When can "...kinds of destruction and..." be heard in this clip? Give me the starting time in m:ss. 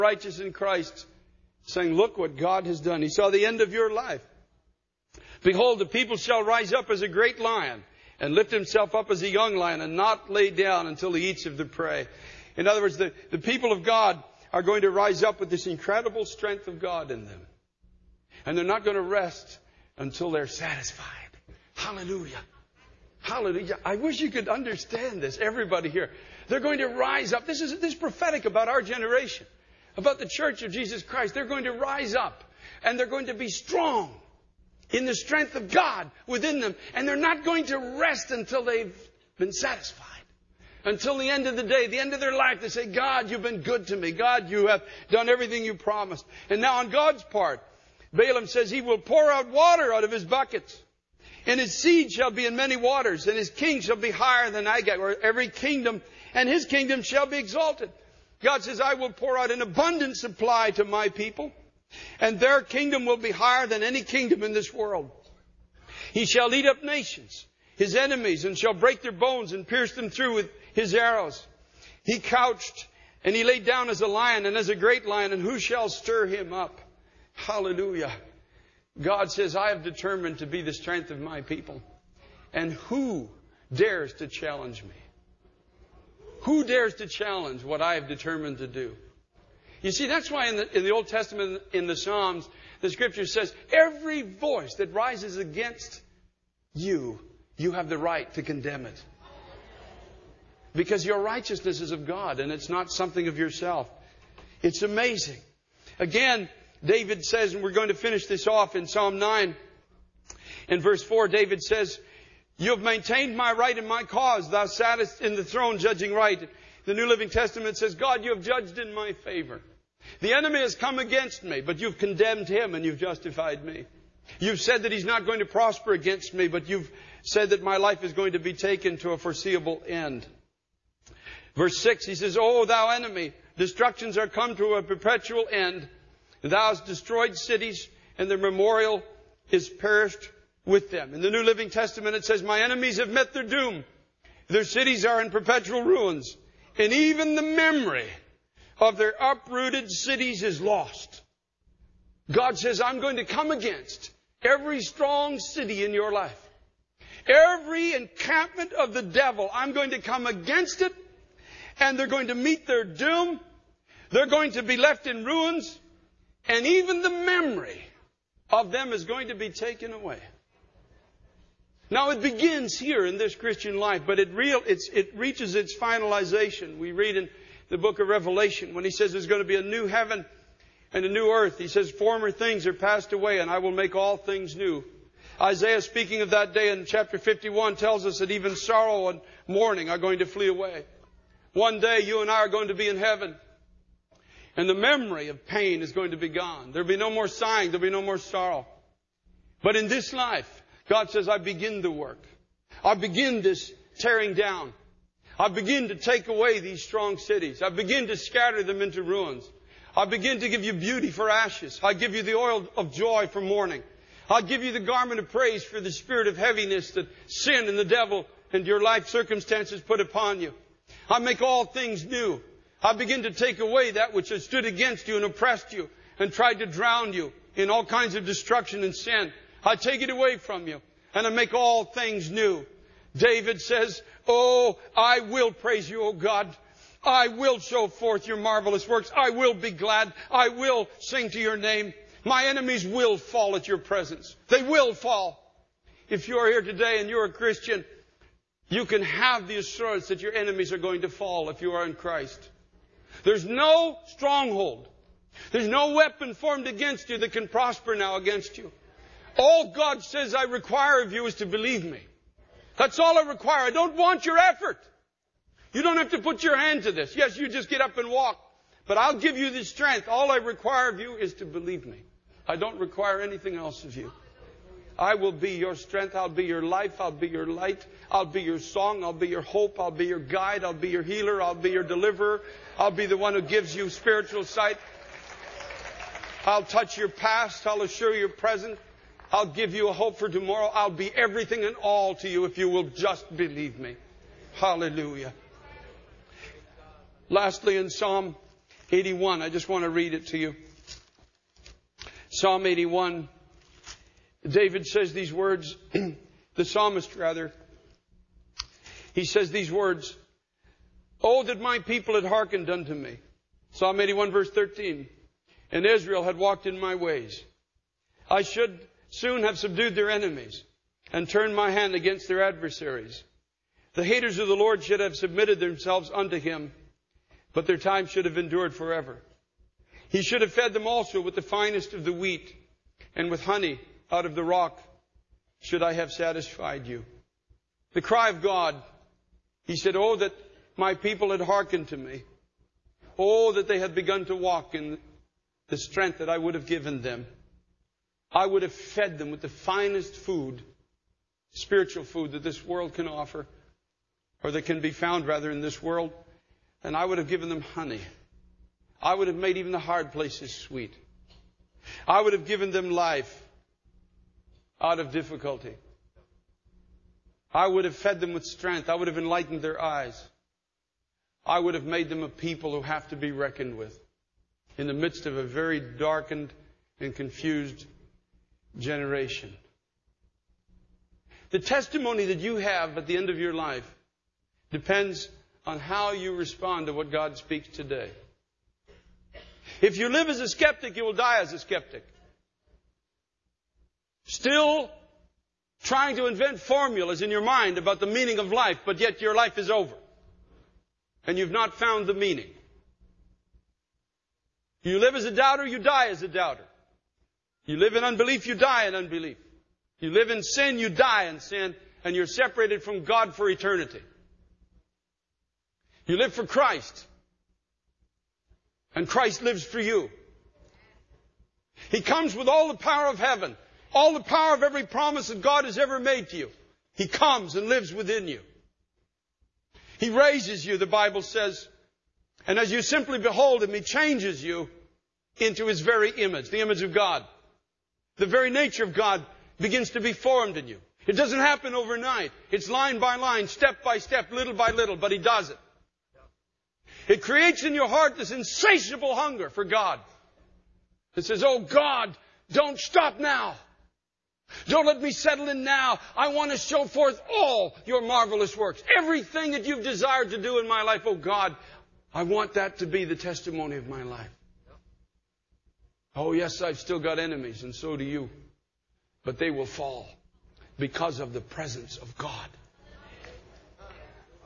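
3:47.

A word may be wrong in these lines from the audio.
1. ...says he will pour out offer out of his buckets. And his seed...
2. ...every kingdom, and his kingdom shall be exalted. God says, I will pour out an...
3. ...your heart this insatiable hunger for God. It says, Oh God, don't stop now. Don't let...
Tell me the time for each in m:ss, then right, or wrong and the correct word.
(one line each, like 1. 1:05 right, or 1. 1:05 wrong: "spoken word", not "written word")
1. 0:48 wrong: "water", not "offer"
2. 0:55 right
3. 7:27 right.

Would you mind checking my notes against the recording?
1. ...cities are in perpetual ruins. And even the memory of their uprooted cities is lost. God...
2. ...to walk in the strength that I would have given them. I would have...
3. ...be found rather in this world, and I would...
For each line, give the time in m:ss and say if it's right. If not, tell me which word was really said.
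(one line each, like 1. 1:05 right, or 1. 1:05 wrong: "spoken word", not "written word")
1. 2:24 right
2. 5:44 right
3. 5:54 right.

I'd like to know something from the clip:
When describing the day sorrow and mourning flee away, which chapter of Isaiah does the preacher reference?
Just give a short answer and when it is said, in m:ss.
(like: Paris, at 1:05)
51, at 3:07.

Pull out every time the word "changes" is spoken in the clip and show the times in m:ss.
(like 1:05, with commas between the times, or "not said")
7:13.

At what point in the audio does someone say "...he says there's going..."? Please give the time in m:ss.
2:58.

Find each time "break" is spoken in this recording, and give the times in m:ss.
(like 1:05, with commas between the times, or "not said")
1:08.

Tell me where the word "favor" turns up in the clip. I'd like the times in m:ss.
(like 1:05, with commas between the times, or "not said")
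1:59.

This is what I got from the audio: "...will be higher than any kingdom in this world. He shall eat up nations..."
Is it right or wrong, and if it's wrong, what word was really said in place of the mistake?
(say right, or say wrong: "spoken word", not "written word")
right.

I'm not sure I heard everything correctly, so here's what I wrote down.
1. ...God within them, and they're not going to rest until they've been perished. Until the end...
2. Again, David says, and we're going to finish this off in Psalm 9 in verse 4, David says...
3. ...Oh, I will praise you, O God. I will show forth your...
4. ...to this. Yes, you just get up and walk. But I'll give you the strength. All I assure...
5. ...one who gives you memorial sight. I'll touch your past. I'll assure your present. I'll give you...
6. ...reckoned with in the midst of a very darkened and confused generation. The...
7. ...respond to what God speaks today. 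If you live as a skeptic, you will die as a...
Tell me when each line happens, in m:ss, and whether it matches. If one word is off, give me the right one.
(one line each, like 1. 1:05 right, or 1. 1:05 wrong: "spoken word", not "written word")
1. 0:35 wrong: "satisfied", not "perished"
2. 1:45 right
3. 3:54 right
4. 4:26 wrong: "require", not "assure"
5. 4:43 wrong: "spiritual", not "memorial"
6. 6:13 right
7. 6:26 right.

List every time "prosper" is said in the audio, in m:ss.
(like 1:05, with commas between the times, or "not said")
2:05, 4:17.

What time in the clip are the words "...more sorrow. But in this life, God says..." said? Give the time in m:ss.
3:18.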